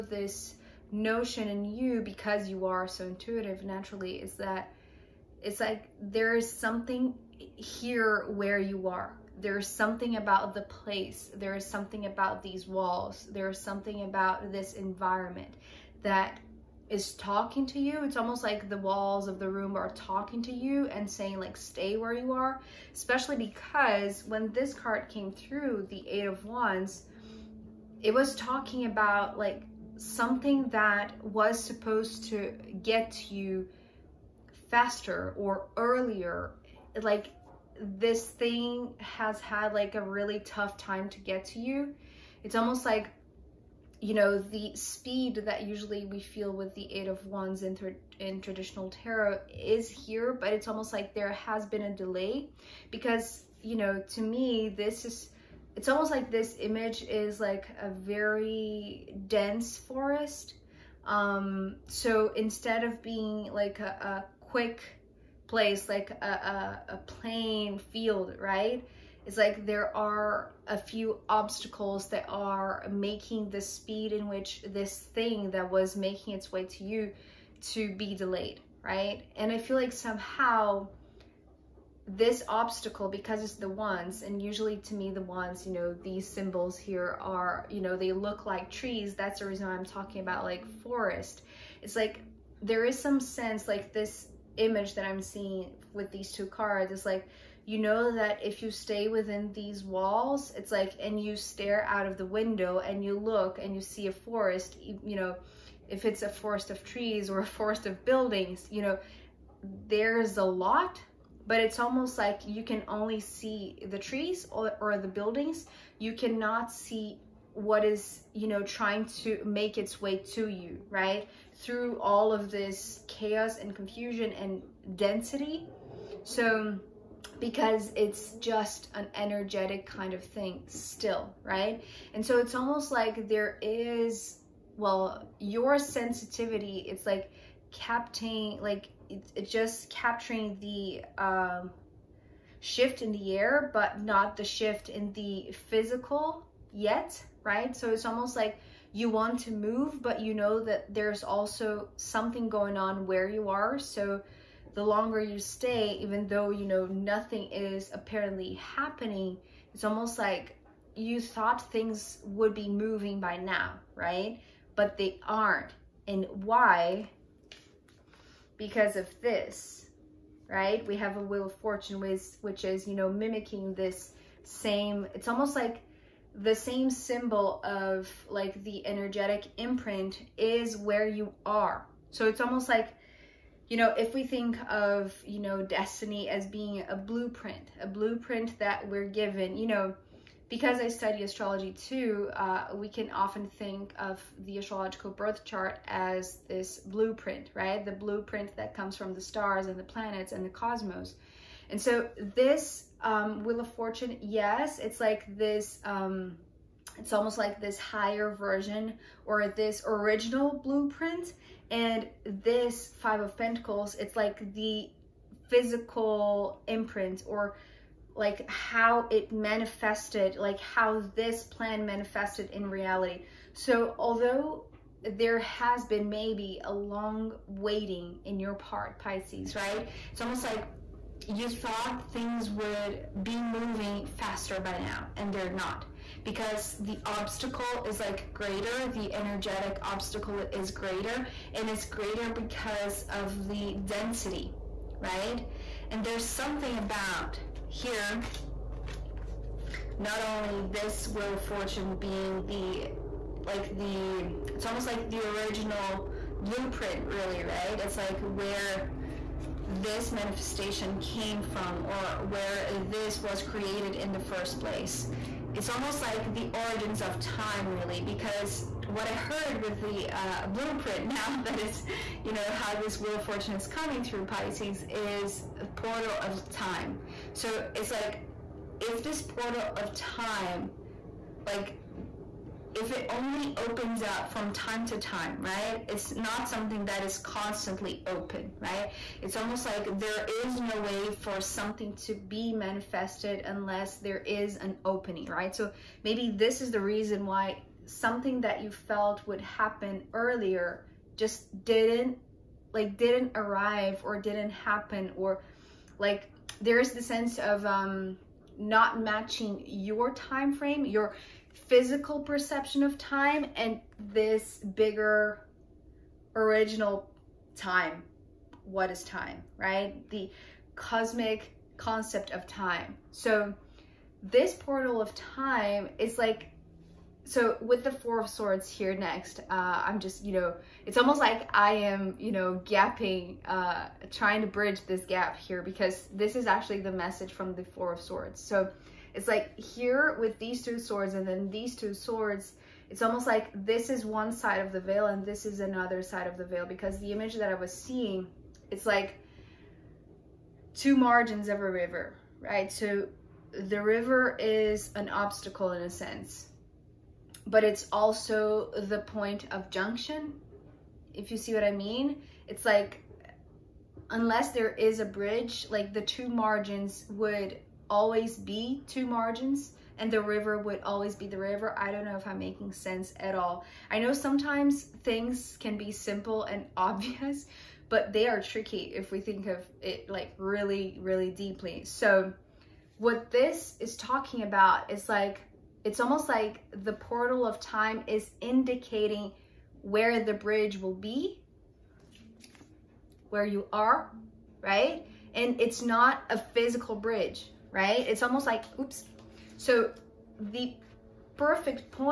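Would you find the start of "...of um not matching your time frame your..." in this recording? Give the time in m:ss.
5:07.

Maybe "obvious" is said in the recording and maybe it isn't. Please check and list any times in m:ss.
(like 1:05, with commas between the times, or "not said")
6:16.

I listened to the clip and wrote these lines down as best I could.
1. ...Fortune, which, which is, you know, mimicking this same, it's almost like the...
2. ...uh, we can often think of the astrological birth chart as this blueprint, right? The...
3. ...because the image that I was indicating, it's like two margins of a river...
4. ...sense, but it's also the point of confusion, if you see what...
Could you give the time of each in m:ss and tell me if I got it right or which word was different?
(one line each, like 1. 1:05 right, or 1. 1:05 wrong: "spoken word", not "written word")
1. 2:51 right
2. 3:12 right
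3. 5:46 wrong: "seeing", not "indicating"
4. 5:55 wrong: "junction", not "confusion".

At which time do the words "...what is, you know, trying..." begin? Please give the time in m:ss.
1:57.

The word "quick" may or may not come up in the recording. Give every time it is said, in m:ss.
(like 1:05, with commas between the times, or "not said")
1:04.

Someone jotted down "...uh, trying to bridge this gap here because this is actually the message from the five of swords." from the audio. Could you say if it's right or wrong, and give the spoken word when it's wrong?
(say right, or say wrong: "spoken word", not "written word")
wrong: "four", not "five".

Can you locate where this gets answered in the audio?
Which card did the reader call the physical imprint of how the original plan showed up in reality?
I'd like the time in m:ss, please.
3:32.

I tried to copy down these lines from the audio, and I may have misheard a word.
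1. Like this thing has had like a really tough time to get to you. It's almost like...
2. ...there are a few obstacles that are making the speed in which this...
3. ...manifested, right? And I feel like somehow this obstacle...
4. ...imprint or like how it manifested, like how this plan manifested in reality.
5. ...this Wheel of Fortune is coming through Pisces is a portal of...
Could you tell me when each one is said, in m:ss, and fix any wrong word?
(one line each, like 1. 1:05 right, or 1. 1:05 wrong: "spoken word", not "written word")
1. 0:37 right
2. 1:09 right
3. 1:18 wrong: "delayed", not "manifested"
4. 3:36 right
5. 4:32 right.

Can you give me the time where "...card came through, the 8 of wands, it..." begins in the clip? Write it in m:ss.
0:24.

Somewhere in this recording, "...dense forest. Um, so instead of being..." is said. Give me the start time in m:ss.
0:59.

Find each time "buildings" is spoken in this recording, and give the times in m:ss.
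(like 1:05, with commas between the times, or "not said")
1:48, 1:55.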